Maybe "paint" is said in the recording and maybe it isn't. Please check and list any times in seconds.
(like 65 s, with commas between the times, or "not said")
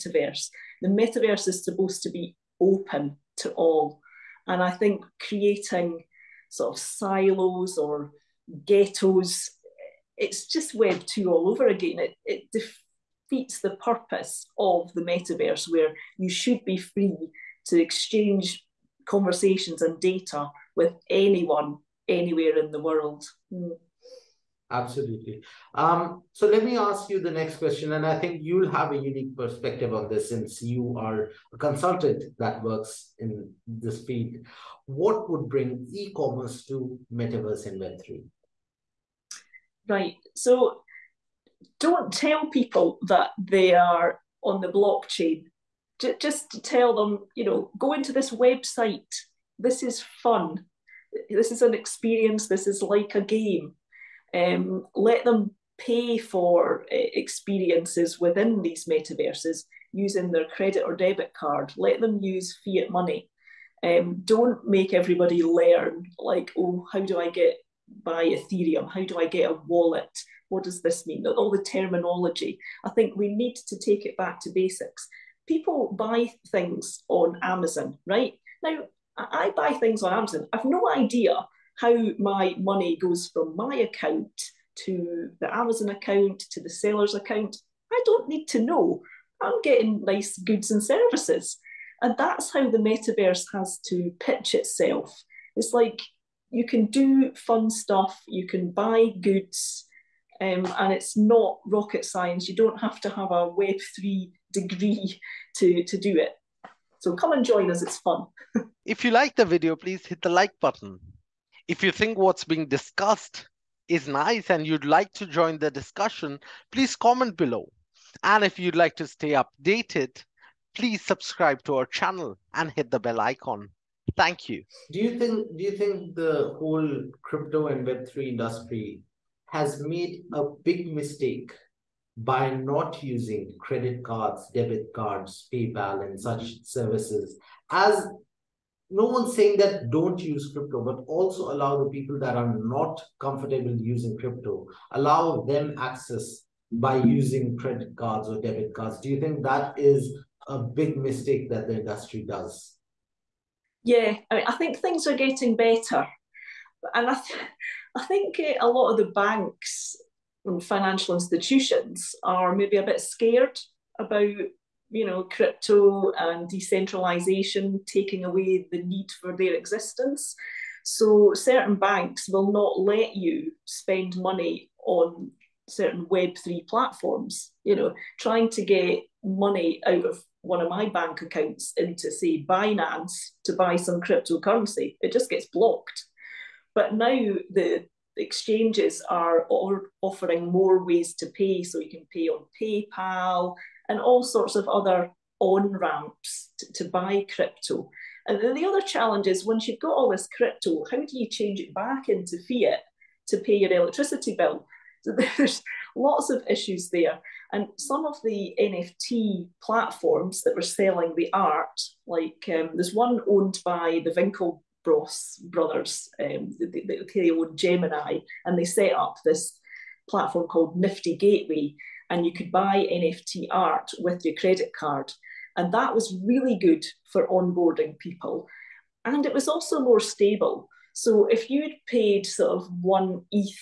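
not said.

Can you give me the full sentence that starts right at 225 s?
And that was really good for onboarding people.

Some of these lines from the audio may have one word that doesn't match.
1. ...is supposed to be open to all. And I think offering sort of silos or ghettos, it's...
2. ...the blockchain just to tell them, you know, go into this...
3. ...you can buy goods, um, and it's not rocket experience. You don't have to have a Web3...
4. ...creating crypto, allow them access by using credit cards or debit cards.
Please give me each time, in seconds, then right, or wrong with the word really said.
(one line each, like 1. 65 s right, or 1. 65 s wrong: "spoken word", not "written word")
1. 1 s wrong: "creating", not "offering"
2. 44 s right
3. 98 s wrong: "science", not "experience"
4. 143 s wrong: "using", not "creating".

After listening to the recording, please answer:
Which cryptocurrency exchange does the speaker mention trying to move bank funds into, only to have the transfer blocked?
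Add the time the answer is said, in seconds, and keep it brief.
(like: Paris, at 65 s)
Binance, at 182 s.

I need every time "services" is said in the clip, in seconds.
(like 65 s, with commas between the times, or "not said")
90 s, 136 s.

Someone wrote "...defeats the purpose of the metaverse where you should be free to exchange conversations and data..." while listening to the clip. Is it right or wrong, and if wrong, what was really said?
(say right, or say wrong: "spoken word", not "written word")
right.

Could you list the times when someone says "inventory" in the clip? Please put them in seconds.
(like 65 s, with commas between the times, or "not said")
37 s.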